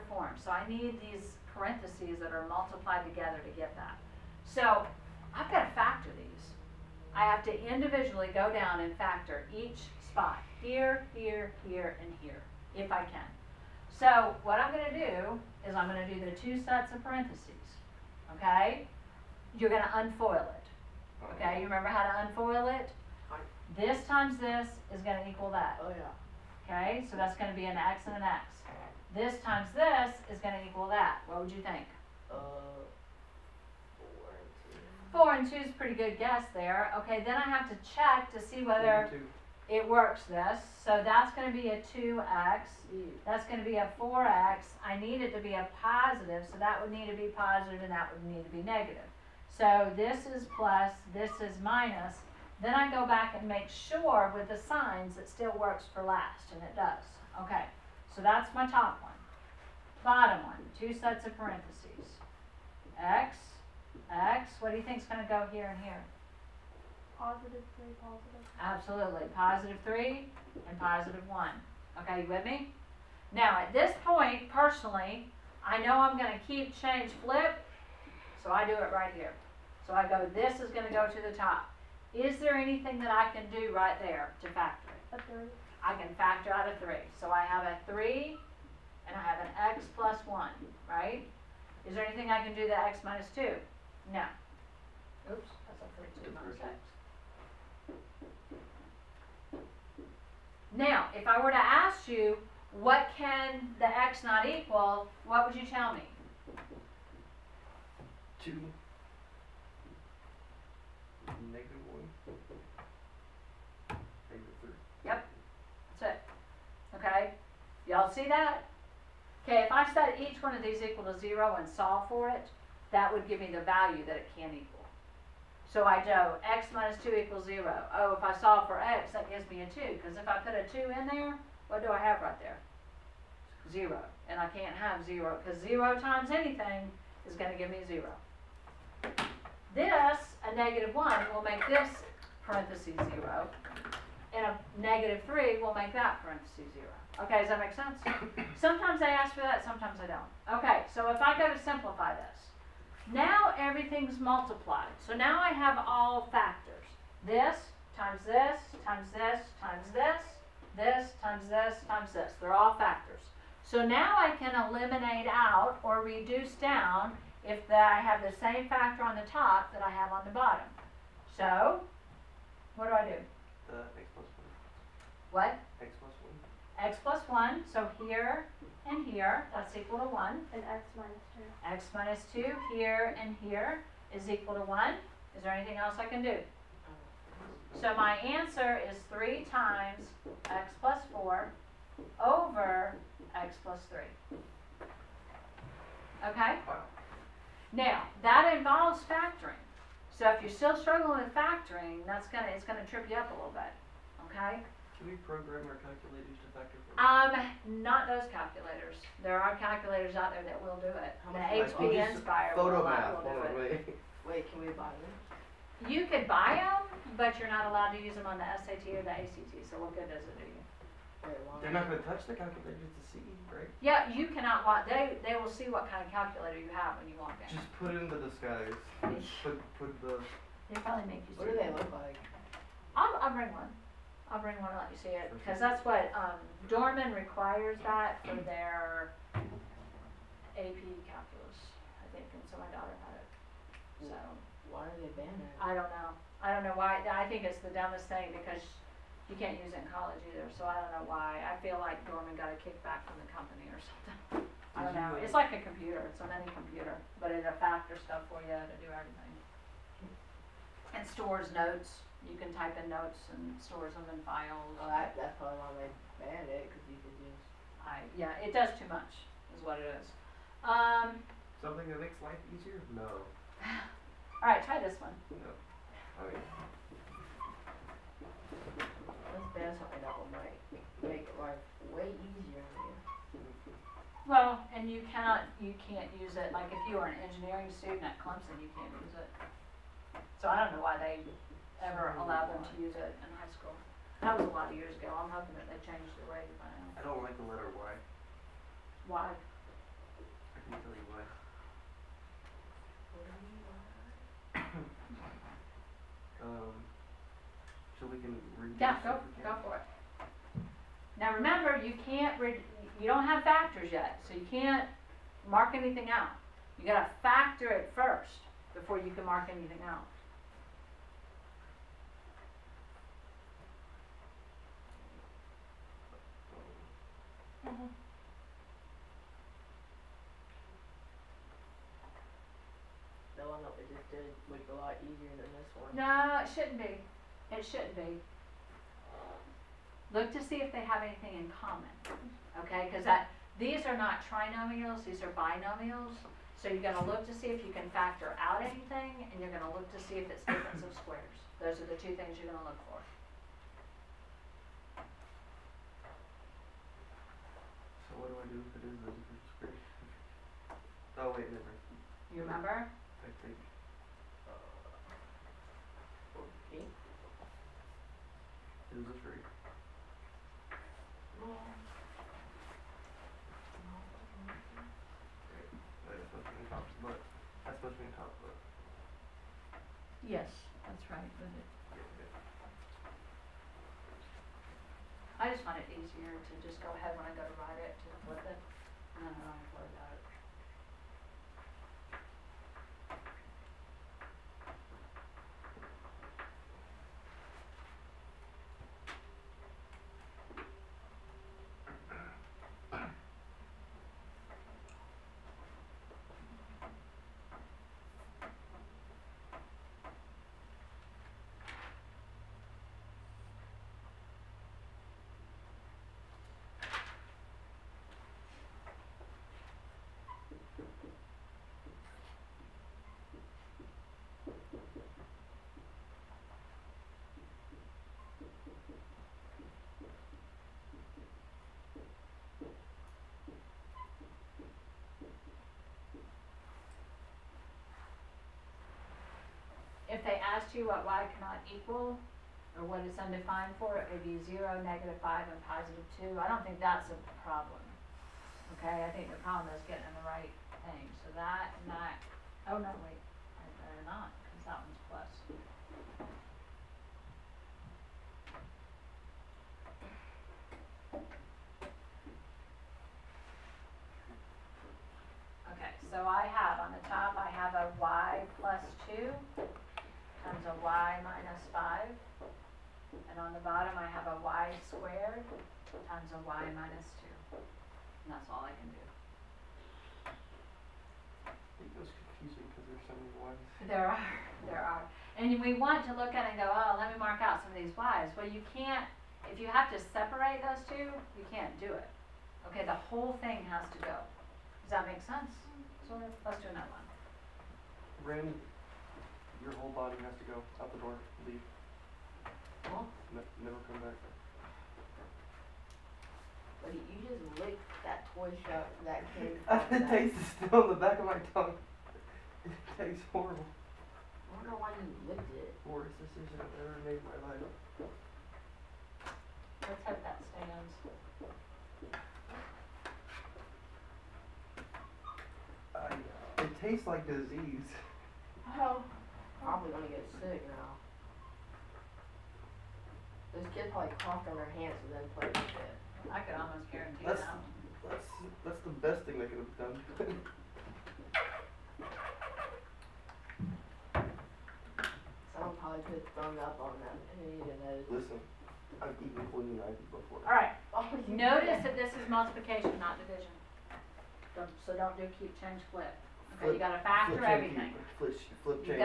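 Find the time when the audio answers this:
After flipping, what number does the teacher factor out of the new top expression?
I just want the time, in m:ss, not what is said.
1:25.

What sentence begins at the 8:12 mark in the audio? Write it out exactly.
Okay, the whole thing has to go.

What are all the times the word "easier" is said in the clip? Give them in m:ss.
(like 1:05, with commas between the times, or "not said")
4:32, 4:42, 5:35, 6:25.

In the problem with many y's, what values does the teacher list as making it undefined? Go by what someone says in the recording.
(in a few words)
0, -5, and 2.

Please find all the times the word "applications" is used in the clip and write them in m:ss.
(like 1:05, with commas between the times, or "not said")
not said.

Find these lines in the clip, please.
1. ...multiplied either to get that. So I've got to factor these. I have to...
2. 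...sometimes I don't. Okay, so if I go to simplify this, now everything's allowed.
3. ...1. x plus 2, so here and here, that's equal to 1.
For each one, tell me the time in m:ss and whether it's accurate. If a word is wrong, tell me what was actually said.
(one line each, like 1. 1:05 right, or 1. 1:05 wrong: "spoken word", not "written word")
1. 0:02 wrong: "together", not "either"
2. 2:29 wrong: "multiplied", not "allowed"
3. 2:56 wrong: "1", not "2".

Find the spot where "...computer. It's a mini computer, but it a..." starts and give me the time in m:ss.
4:15.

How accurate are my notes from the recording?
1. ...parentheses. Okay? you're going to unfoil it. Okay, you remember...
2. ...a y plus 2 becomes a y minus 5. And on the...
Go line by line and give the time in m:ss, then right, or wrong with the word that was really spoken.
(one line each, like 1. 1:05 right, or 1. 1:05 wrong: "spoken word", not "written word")
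1. 0:17 right
2. 7:47 right.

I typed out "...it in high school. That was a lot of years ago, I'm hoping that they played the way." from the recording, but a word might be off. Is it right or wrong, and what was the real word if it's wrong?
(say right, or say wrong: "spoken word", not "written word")
wrong: "changed", not "played".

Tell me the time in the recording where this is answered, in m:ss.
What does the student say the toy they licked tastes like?
8:46.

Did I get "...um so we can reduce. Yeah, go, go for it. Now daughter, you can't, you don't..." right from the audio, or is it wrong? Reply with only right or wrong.
wrong.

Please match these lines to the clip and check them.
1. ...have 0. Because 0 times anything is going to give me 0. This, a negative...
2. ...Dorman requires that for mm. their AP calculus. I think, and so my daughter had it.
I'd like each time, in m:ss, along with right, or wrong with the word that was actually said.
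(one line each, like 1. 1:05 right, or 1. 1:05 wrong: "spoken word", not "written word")
1. 2:14 right
2. 3:56 right.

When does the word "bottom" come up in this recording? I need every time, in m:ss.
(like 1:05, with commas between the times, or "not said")
1:00, 2:50, 7:53.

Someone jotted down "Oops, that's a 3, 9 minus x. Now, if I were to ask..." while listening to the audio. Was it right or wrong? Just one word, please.
wrong.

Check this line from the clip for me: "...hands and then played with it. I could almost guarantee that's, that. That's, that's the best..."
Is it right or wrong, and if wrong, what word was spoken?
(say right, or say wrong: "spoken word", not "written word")
right.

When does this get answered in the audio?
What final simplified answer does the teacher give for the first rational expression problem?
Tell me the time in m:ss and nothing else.
3:09.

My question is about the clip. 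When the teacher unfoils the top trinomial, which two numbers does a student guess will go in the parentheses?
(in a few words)
4 and 2.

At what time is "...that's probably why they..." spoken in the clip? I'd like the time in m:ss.
4:25.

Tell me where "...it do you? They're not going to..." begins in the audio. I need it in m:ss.
3:40.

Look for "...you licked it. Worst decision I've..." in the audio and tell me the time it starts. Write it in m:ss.
8:34.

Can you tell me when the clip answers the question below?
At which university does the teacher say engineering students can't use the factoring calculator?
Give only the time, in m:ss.
4:48.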